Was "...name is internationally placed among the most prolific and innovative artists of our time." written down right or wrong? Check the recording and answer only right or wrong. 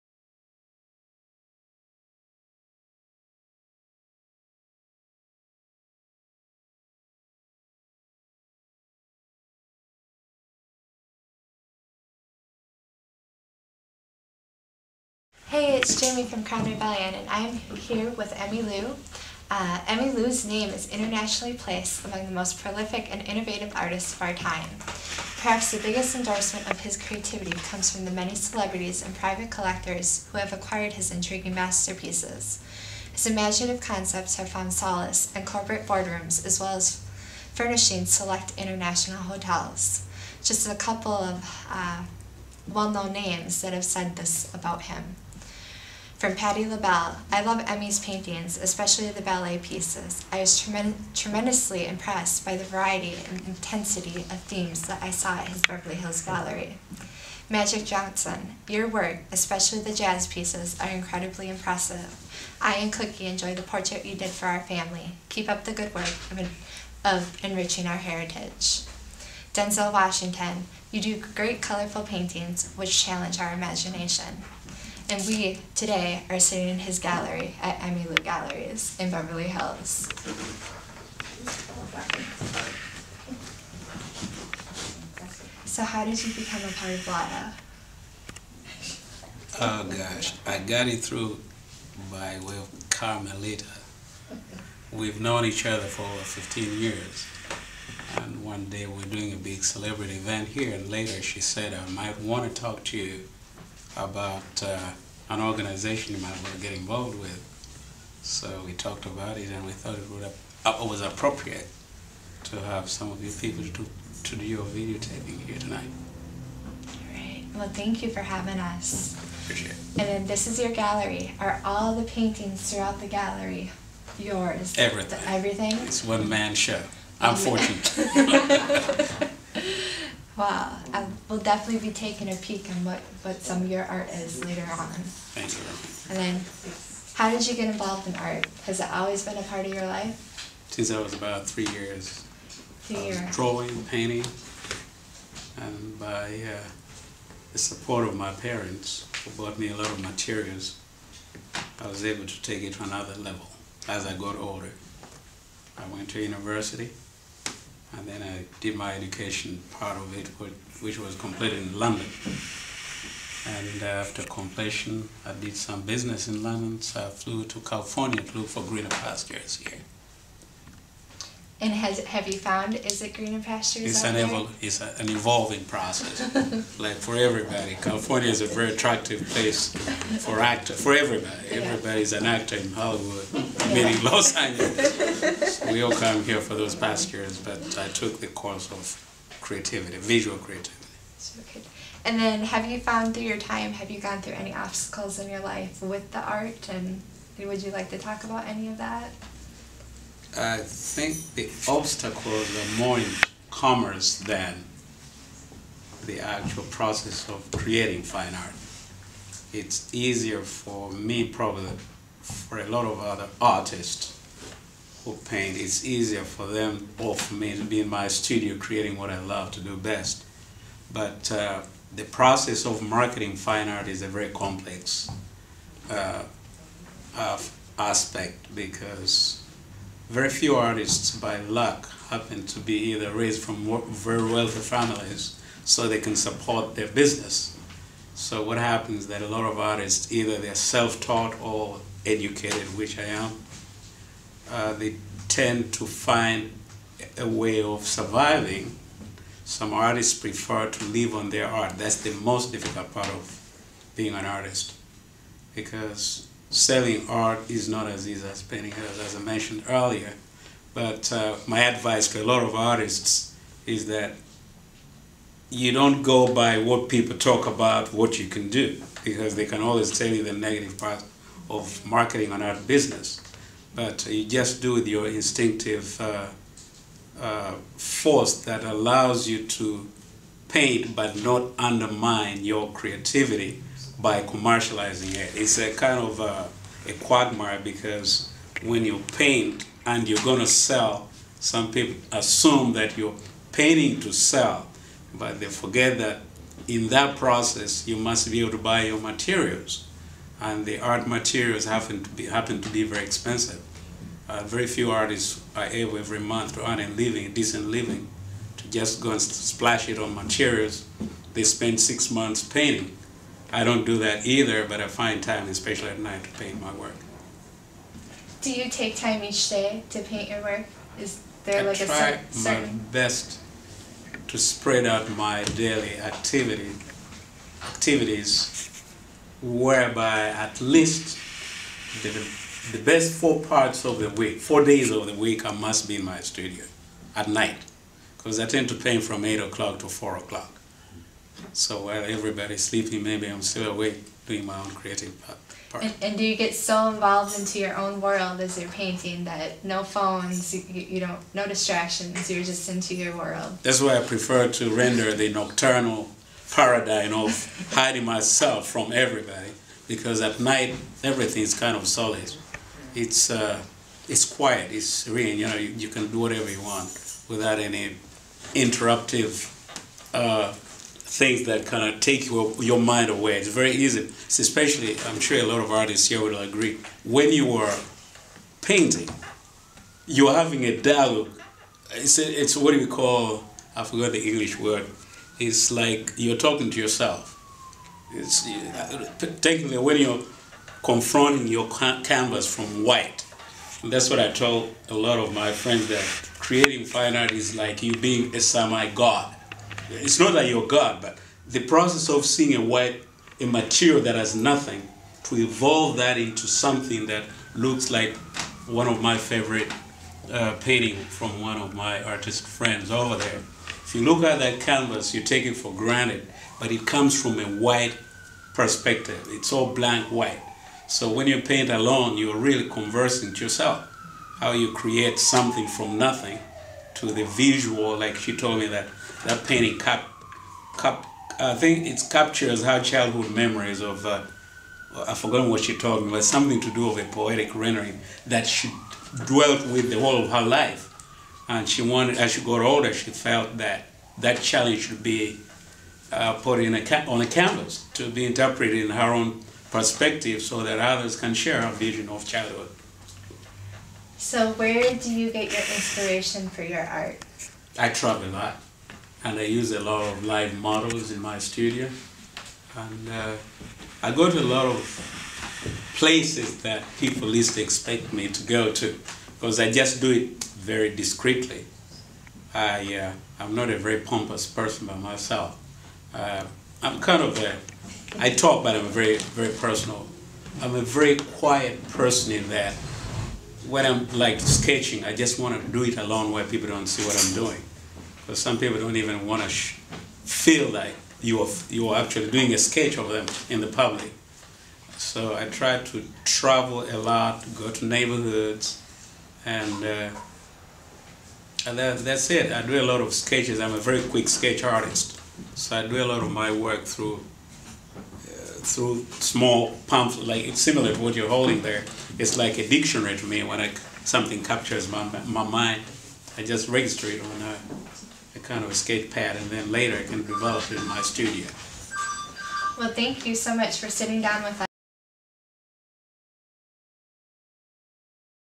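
right.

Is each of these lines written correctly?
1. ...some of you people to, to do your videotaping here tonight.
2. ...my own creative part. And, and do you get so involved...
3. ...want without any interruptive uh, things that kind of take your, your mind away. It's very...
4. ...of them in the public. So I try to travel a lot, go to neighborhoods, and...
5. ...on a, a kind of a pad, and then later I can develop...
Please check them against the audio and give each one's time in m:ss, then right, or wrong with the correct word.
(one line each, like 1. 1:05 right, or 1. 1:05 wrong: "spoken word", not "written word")
1. 1:52 right
2. 5:44 right
3. 6:06 right
4. 8:12 right
5. 8:37 right.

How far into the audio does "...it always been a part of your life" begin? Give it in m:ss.
2:18.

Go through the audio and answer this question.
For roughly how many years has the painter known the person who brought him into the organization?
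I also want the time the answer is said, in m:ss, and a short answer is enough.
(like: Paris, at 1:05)
15, at 1:36.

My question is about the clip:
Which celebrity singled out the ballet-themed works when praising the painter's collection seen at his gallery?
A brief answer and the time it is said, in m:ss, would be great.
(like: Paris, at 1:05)
Patti LaBelle, at 0:46.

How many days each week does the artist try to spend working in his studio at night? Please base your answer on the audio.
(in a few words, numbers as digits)
4.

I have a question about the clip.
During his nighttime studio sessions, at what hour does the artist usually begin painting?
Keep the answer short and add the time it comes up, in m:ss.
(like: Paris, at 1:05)
8 o'clock, at 5:39.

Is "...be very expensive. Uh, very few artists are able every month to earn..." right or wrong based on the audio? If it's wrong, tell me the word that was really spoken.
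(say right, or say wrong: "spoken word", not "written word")
right.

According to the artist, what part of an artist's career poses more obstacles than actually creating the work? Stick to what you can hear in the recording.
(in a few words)
commerce.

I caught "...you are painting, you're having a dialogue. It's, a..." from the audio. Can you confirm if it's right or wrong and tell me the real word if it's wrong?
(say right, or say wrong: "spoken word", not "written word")
right.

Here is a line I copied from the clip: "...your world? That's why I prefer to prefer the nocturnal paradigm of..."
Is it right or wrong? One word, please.
wrong.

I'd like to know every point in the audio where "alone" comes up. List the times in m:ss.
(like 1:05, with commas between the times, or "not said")
7:01, 8:05.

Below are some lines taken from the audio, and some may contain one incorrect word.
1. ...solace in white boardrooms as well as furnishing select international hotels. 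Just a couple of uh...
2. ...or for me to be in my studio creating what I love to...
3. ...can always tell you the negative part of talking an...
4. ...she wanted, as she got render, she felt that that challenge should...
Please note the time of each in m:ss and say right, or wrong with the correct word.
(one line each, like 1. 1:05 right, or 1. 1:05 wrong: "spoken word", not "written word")
1. 0:34 wrong: "corporate", not "white"
2. 3:36 right
3. 4:29 wrong: "marketing", not "talking"
4. 7:21 wrong: "older", not "render".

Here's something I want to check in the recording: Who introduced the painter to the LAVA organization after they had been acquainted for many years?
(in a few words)
Carmelita.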